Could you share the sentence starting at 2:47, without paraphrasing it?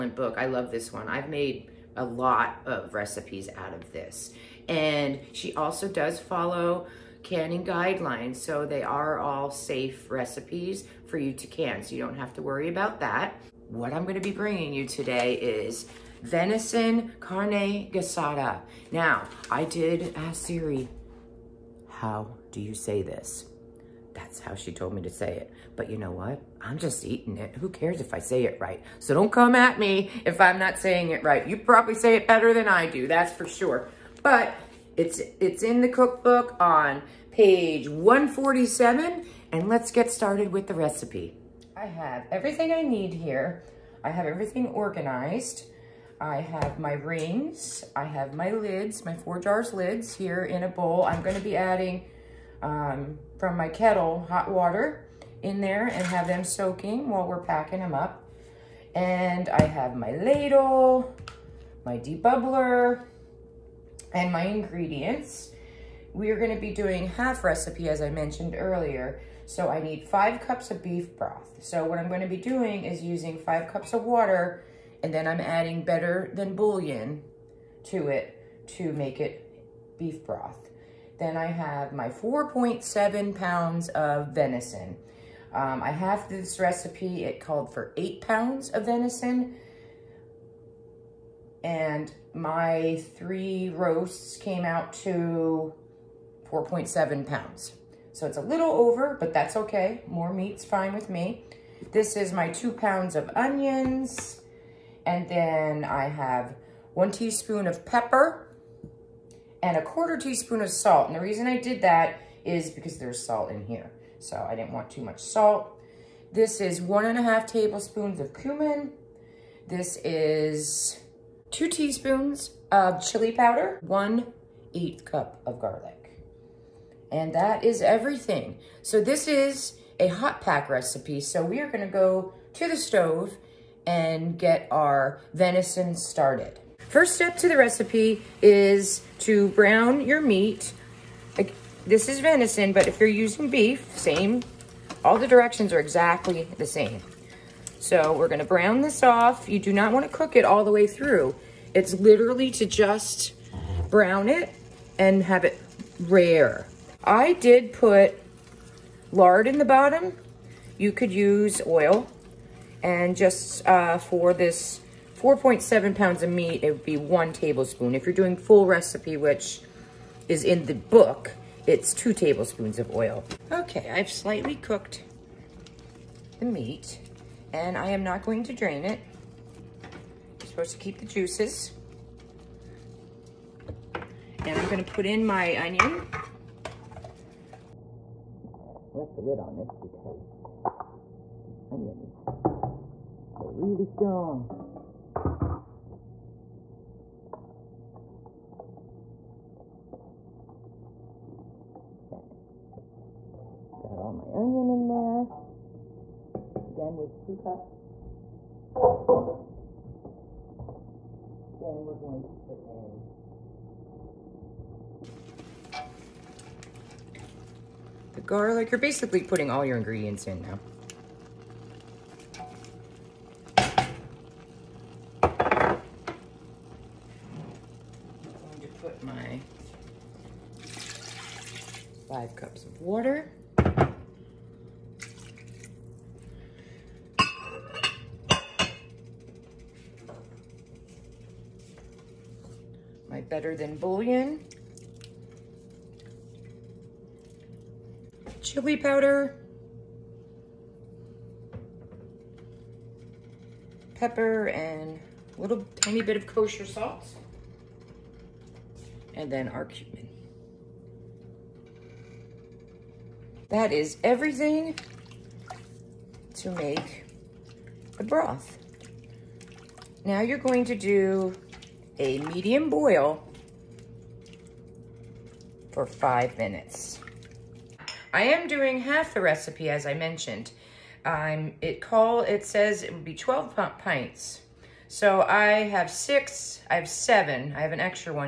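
If you're doing full recipe, which is in the book, it's two tablespoons of oil.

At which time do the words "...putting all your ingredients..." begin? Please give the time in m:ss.
3:39.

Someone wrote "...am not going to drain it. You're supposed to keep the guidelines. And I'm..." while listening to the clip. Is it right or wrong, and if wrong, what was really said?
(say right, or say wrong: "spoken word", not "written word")
wrong: "juices", not "guidelines".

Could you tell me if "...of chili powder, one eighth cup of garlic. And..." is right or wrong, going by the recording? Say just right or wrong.
right.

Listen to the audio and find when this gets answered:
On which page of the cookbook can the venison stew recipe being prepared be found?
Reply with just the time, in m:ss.
0:37.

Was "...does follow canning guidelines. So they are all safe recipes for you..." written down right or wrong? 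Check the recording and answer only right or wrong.
right.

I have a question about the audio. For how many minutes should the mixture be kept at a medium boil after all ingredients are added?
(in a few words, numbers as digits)
5 minutes.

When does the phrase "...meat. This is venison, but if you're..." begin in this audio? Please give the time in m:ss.
2:20.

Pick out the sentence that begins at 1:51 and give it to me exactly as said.
And the reason I did that is because there's salt in here.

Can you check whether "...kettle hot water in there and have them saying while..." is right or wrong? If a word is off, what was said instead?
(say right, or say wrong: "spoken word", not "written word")
wrong: "soaking", not "saying".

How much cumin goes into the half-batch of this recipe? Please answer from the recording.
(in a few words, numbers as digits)
1.5 tablespoons.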